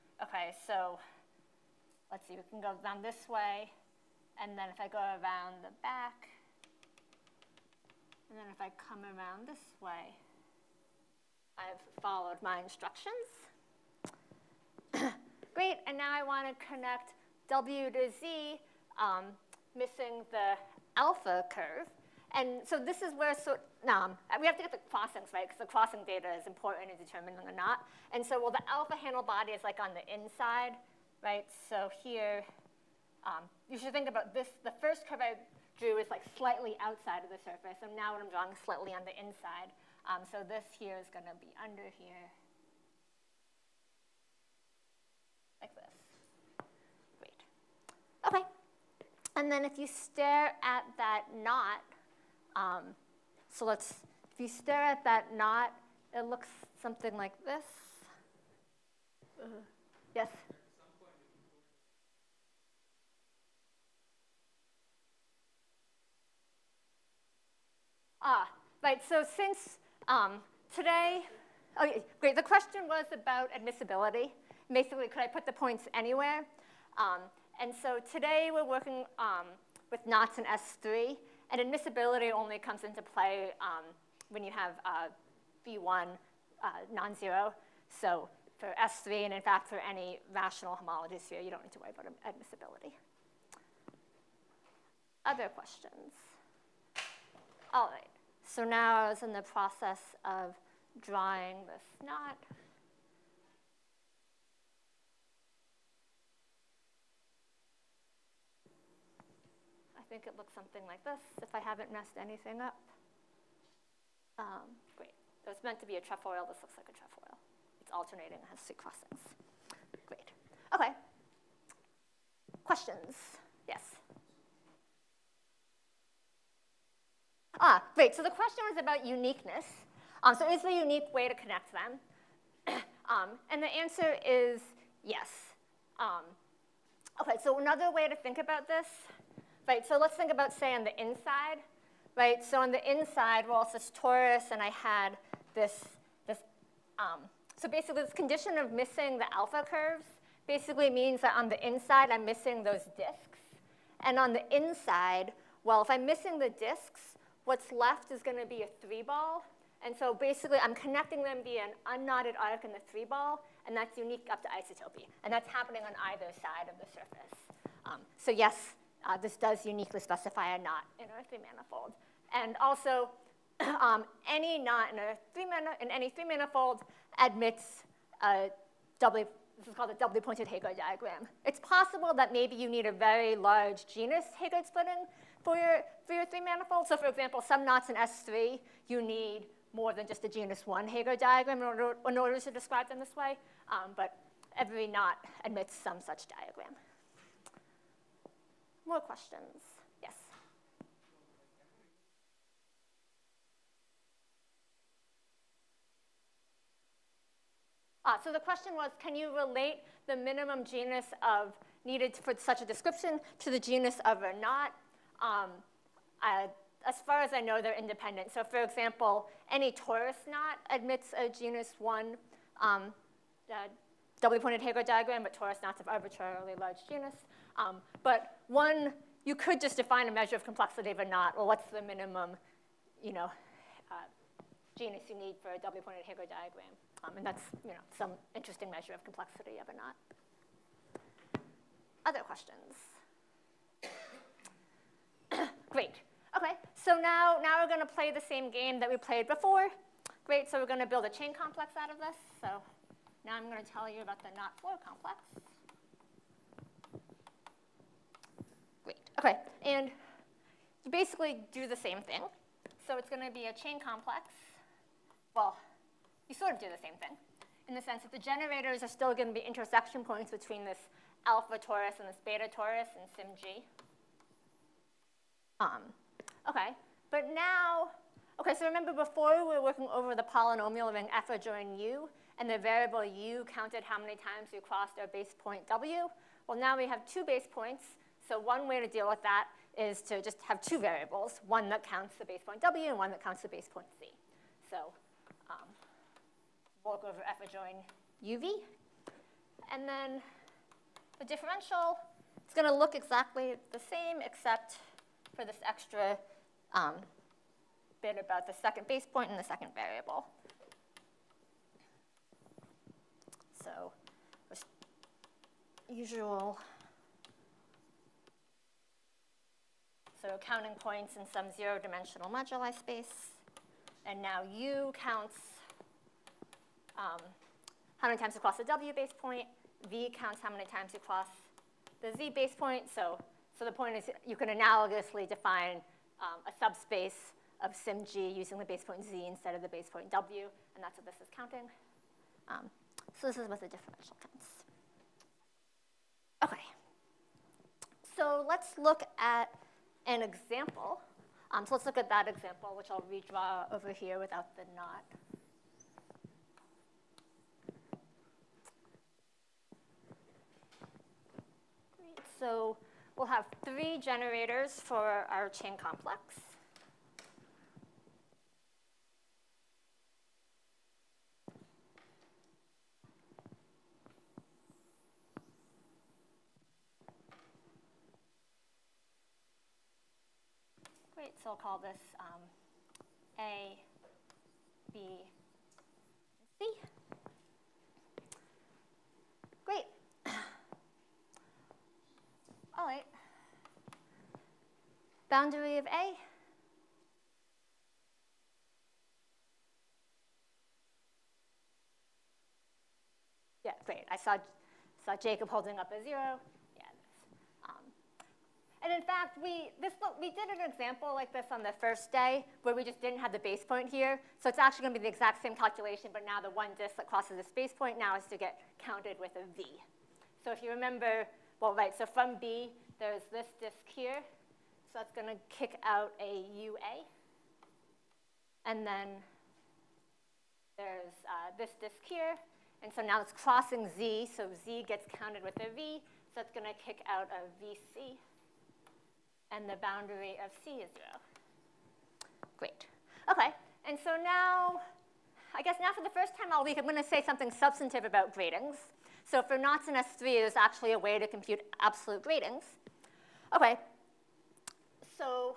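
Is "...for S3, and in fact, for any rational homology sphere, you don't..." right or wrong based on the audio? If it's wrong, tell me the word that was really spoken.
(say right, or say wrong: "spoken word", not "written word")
right.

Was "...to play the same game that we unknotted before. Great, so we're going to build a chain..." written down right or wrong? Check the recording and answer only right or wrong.
wrong.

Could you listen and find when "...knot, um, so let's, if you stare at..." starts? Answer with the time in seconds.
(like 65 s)
51 s.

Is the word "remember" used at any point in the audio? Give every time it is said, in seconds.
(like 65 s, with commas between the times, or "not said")
278 s, 420 s.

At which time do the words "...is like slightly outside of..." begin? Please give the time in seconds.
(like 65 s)
35 s.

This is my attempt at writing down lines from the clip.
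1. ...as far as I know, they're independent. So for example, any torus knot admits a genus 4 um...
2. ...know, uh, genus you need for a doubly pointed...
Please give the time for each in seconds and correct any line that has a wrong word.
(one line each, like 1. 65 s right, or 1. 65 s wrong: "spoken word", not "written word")
1. 216 s wrong: "1", not "4"
2. 233 s right.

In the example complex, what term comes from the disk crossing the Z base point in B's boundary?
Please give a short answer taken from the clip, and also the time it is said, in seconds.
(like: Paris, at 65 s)
VC, at 437 s.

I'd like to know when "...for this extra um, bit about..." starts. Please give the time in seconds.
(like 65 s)
305 s.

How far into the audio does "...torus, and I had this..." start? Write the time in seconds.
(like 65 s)
144 s.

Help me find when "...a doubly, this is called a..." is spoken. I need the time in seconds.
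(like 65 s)
178 s.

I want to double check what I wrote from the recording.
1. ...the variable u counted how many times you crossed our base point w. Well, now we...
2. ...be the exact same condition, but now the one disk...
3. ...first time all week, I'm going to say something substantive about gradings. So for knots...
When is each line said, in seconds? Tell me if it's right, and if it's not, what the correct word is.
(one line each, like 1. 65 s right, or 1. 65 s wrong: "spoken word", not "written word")
1. 282 s right
2. 415 s wrong: "calculation", not "condition"
3. 446 s right.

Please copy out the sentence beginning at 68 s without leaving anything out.
Ah, right, so since um, today, oh, great, the question was about admissibility.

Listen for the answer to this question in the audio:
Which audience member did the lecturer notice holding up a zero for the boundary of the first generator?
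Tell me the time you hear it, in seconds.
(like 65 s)
405 s.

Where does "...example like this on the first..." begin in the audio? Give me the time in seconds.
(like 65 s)
410 s.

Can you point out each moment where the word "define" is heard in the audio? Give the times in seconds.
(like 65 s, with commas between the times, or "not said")
229 s, 335 s.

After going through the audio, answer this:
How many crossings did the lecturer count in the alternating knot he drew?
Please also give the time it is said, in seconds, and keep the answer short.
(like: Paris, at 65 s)
3, at 118 s.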